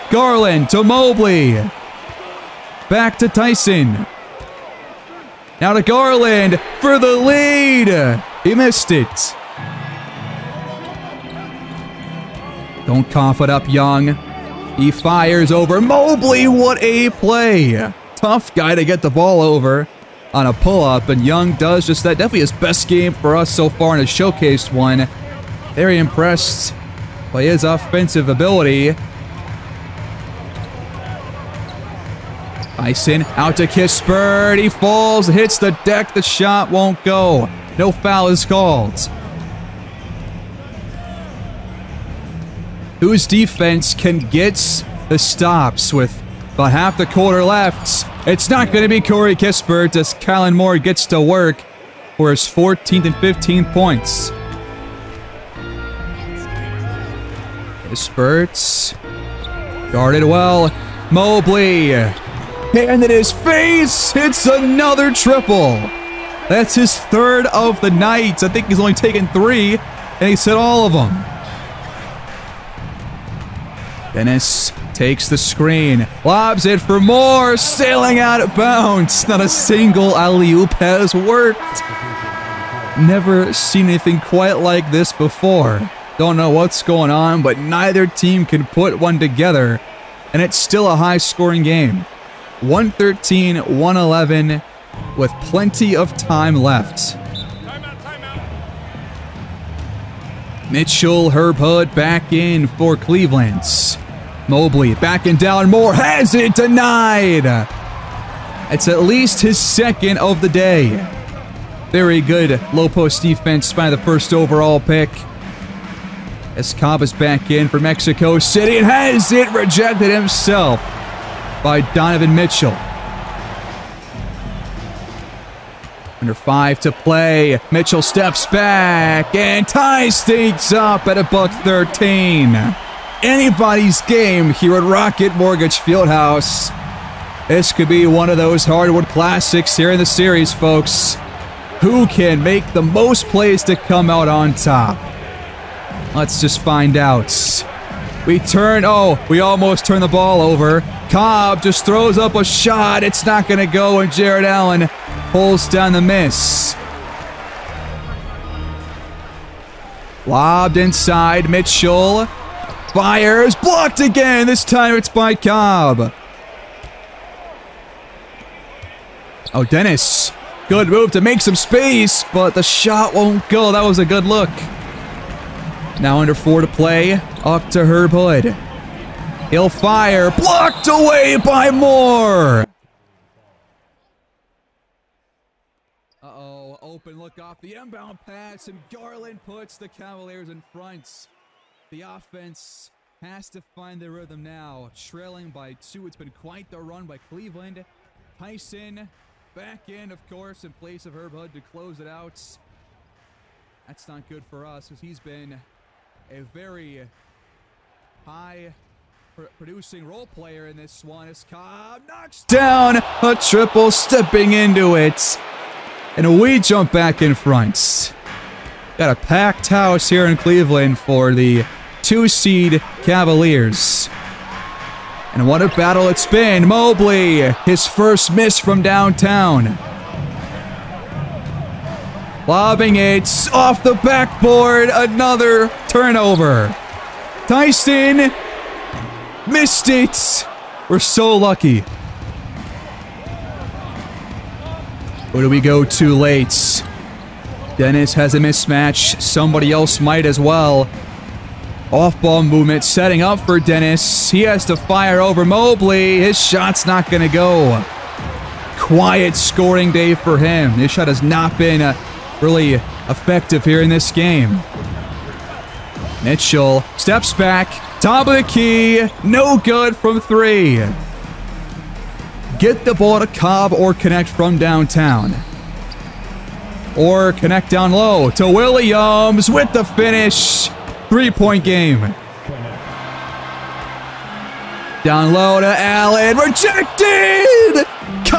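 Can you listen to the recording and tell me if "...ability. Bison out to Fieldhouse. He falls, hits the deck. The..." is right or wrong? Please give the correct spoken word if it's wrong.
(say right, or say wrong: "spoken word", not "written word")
wrong: "Kispert", not "Fieldhouse".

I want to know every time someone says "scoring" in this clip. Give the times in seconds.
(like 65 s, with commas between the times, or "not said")
91 s, 259 s.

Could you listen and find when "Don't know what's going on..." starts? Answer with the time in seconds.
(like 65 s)
86 s.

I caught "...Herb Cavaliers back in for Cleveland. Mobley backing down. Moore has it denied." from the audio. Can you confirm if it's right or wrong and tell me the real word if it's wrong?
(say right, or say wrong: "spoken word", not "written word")
wrong: "Hood", not "Cavaliers".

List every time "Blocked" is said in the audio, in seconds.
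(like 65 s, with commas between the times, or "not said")
163 s, 180 s.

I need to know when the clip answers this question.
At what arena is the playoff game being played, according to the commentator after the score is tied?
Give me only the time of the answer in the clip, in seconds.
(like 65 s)
134 s.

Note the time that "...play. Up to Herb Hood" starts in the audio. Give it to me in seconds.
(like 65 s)
176 s.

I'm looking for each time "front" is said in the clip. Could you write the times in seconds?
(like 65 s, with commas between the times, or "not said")
190 s, 217 s.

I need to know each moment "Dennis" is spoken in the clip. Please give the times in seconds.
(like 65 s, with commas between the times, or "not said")
74 s, 169 s, 247 s, 253 s.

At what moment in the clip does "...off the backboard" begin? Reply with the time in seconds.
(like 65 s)
233 s.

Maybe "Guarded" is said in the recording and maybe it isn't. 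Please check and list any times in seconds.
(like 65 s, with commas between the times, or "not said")
59 s.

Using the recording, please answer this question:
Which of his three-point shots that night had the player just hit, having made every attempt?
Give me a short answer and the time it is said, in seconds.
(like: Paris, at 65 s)
third, at 66 s.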